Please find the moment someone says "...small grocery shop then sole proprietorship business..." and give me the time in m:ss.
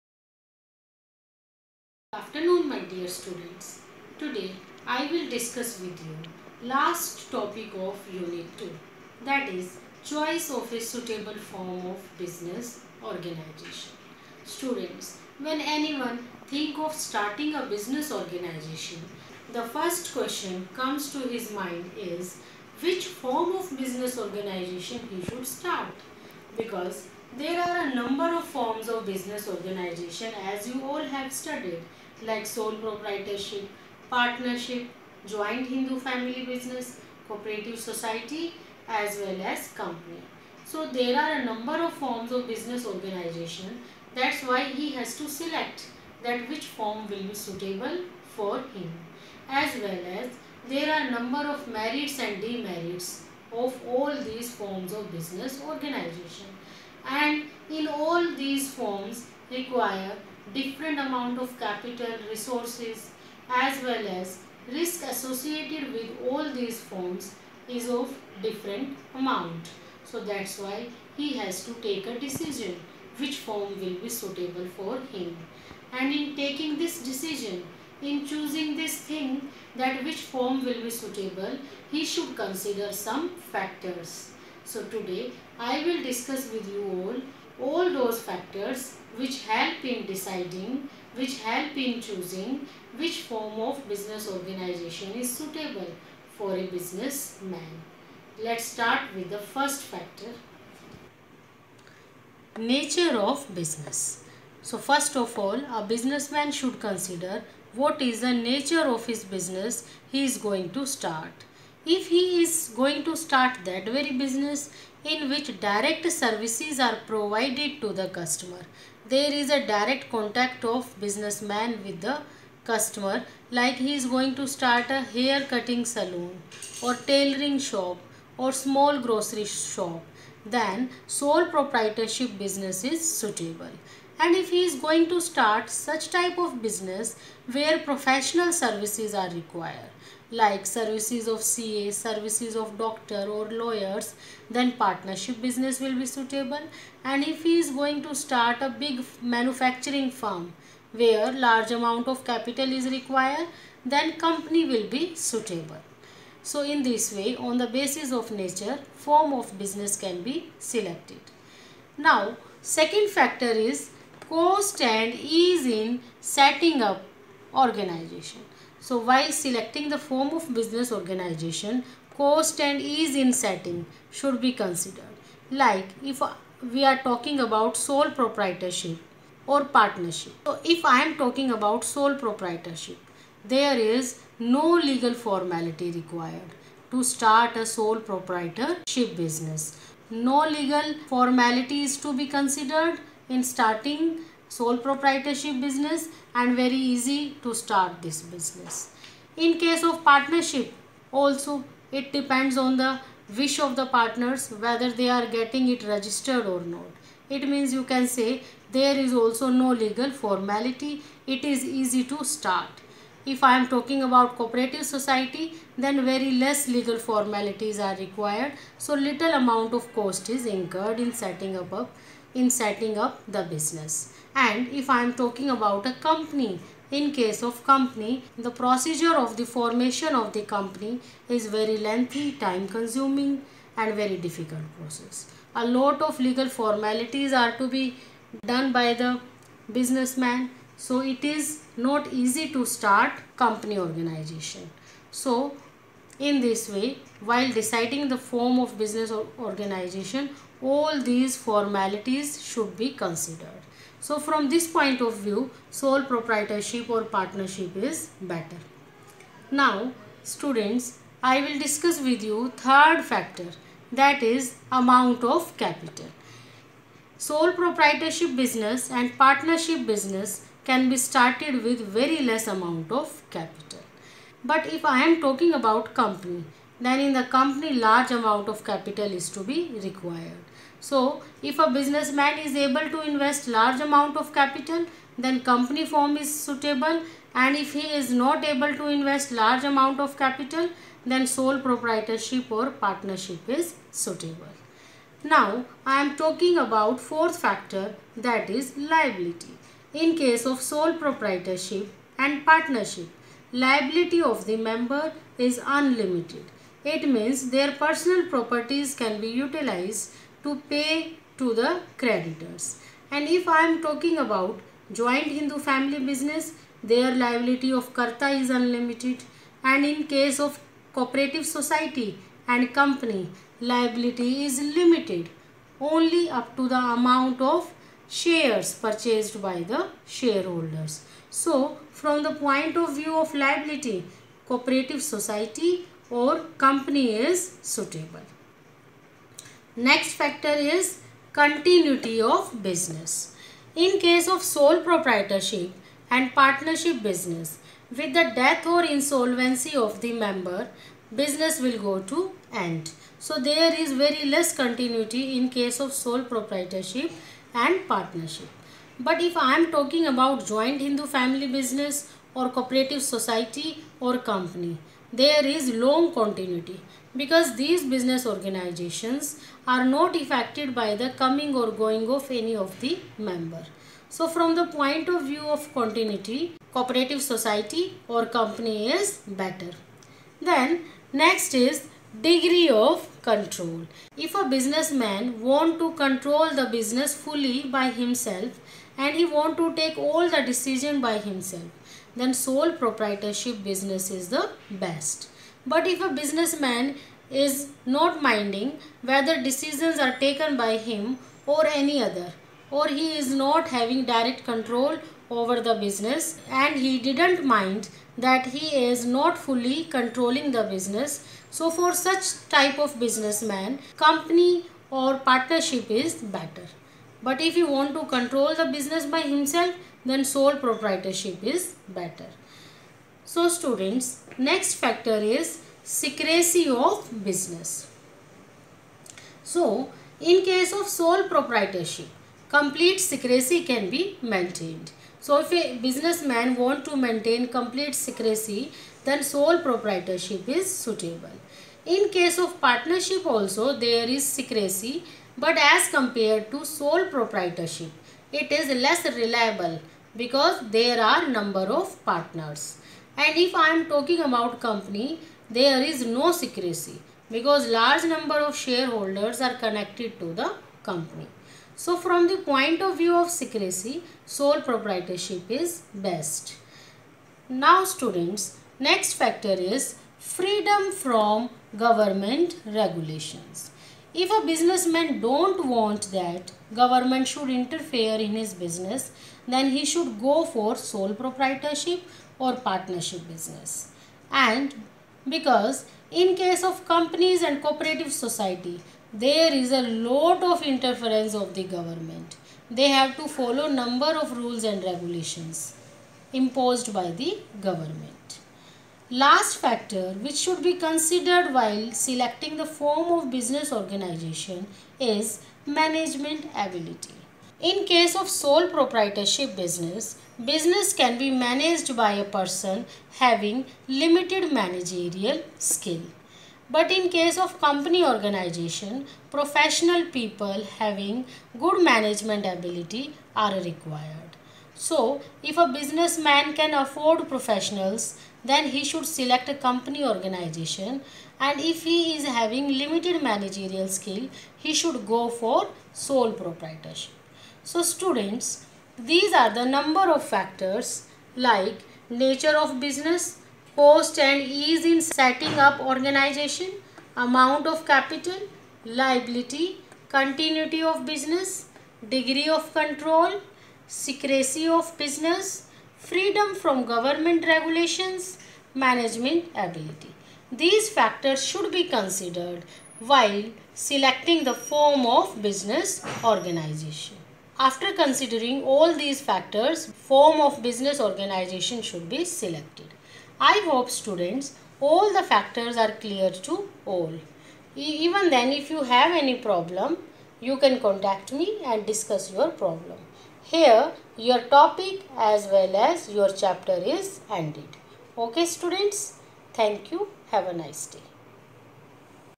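2:08.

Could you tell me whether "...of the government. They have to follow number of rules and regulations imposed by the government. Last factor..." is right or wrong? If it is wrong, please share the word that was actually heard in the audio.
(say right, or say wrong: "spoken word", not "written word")
right.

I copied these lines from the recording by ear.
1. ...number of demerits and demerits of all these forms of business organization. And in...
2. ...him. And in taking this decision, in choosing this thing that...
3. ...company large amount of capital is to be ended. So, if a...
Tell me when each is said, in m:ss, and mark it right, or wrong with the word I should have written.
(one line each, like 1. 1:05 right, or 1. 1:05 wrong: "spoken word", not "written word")
1. 0:51 wrong: "merits", not "demerits"
2. 1:15 right
3. 4:37 wrong: "required", not "ended".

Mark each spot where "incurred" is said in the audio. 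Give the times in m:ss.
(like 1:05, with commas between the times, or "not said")
3:40.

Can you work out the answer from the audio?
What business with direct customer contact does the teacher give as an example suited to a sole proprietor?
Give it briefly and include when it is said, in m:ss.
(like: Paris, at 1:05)
Hair cutting salon, at 2:05.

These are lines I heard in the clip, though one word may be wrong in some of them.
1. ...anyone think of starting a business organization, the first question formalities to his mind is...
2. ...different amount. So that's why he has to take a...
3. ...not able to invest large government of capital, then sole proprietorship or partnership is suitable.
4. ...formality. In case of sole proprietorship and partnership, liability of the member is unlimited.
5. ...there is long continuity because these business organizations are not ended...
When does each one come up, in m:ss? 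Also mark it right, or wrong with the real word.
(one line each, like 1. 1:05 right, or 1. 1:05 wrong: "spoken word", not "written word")
1. 0:15 wrong: "comes", not "formalities"
2. 1:08 right
3. 4:48 wrong: "amount", not "government"
4. 4:58 wrong: "liability", not "formality"
5. 6:05 wrong: "affected", not "ended".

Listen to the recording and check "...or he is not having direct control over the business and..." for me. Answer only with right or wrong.
right.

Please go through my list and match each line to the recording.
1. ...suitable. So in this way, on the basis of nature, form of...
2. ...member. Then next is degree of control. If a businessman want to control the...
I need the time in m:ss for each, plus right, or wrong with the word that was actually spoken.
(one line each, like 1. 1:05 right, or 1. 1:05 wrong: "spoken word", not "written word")
1. 2:35 right
2. 6:19 wrong: "better", not "member".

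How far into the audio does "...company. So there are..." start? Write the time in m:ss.
0:39.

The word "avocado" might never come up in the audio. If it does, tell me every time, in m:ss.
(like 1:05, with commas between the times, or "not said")
not said.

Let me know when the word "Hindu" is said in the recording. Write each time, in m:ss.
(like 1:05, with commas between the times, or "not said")
0:35, 5:15, 6:00.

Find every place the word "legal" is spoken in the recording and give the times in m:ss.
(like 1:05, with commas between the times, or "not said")
3:04, 3:10, 3:29, 3:36, 3:56.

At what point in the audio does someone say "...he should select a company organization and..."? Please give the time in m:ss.
8:48.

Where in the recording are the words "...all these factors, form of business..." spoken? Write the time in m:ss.
9:28.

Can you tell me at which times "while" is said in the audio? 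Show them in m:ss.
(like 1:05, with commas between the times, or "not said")
2:48, 4:07, 8:21, 9:22.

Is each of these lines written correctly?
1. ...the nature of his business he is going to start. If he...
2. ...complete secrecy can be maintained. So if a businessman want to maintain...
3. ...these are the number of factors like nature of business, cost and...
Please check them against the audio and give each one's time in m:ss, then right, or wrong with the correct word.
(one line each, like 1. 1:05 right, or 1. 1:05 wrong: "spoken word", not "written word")
1. 1:48 right
2. 7:12 right
3. 8:58 right.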